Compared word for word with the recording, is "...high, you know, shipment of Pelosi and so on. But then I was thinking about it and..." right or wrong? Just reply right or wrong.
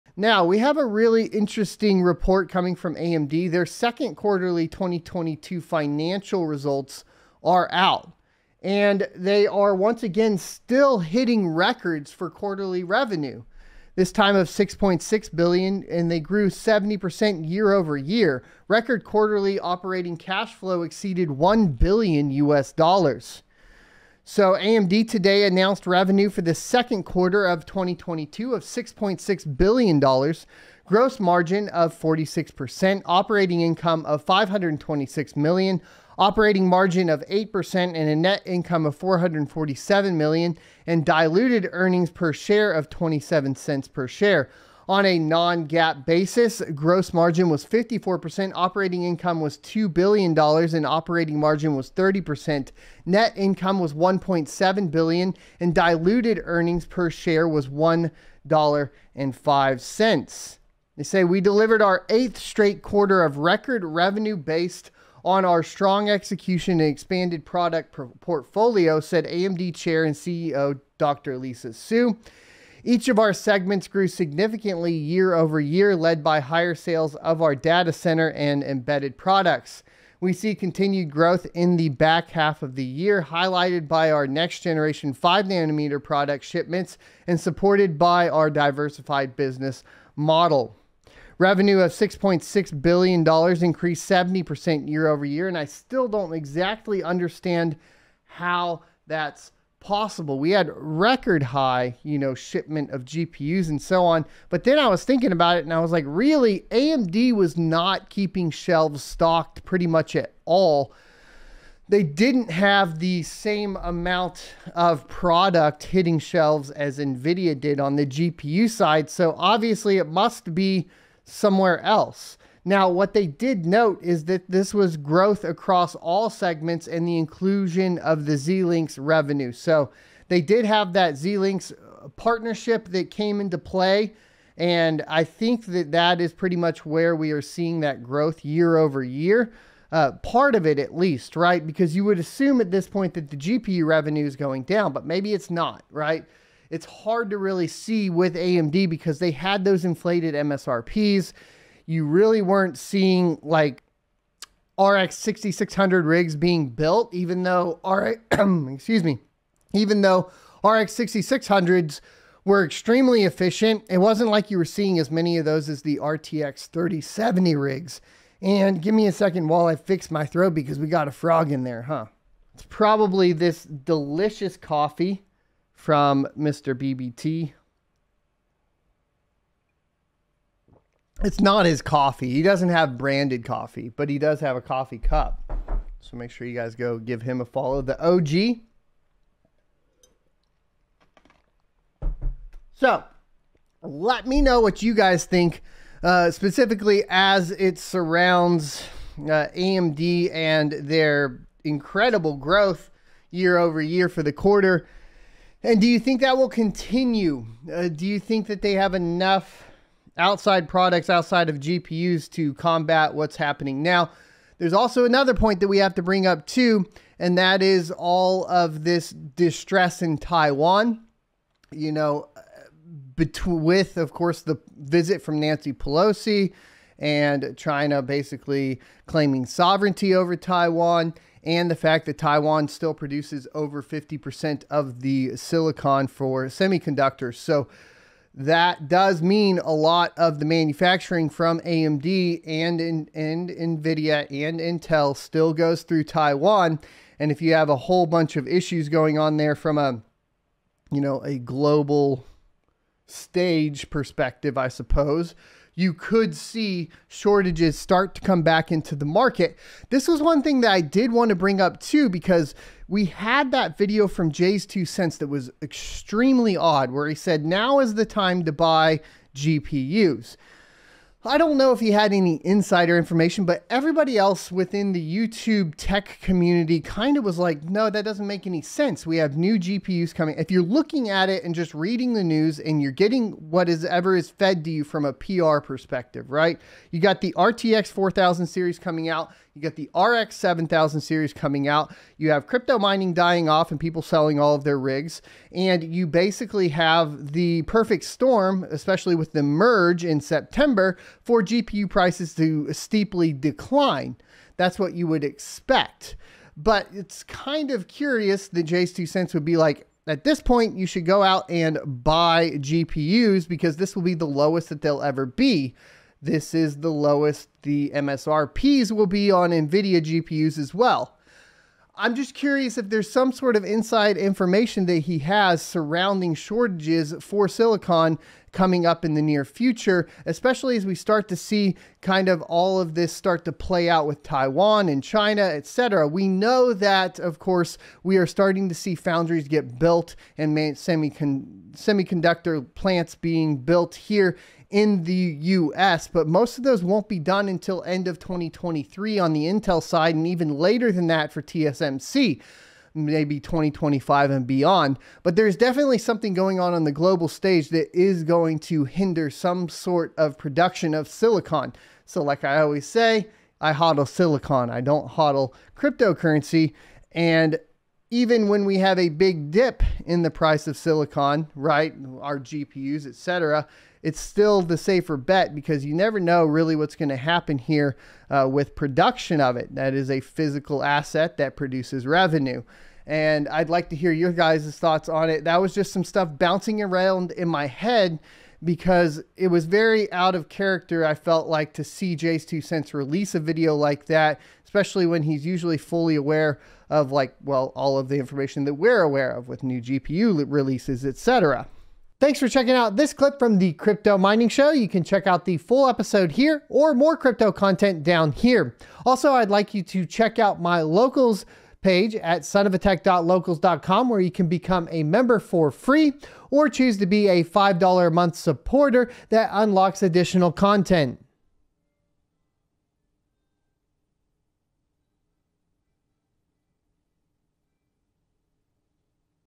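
wrong.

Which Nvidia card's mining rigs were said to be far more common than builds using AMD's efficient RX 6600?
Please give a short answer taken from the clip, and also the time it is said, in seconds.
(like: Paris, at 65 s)
RTX 3070, at 165 s.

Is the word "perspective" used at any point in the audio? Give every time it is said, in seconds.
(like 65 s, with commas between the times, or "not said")
253 s, 285 s.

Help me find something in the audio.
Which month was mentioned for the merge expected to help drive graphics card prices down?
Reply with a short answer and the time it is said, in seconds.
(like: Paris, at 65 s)
September, at 300 s.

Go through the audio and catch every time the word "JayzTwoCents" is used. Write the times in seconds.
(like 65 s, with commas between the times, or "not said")
264 s, 308 s, 392 s.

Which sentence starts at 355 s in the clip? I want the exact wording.
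But there's definitely something going on on the global stage that is going to hinder some sort of production of silicon.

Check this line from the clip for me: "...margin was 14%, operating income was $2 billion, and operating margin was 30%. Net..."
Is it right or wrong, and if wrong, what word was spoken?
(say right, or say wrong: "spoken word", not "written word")
wrong: "54", not "14".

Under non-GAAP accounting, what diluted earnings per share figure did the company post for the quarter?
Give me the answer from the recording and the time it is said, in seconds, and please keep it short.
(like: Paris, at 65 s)
$1.05, at 57 s.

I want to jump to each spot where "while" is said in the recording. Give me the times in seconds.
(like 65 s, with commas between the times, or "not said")
169 s.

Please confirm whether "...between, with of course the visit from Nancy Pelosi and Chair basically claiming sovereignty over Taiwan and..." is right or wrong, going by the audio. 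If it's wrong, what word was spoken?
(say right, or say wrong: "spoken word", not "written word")
wrong: "China", not "Chair".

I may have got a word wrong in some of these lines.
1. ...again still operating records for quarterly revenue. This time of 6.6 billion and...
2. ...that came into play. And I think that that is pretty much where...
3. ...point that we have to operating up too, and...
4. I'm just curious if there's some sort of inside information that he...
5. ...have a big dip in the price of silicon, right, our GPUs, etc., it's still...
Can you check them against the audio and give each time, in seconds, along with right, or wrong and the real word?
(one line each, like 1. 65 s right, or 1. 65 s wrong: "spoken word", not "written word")
1. 10 s wrong: "hitting", not "operating"
2. 132 s right
3. 215 s wrong: "bring", not "operating"
4. 321 s right
5. 368 s right.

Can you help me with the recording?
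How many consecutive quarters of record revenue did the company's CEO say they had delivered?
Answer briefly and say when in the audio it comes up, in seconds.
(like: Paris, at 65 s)
8, at 62 s.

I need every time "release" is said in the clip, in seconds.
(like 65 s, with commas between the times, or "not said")
392 s, 400 s.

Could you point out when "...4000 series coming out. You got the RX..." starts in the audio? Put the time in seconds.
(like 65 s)
287 s.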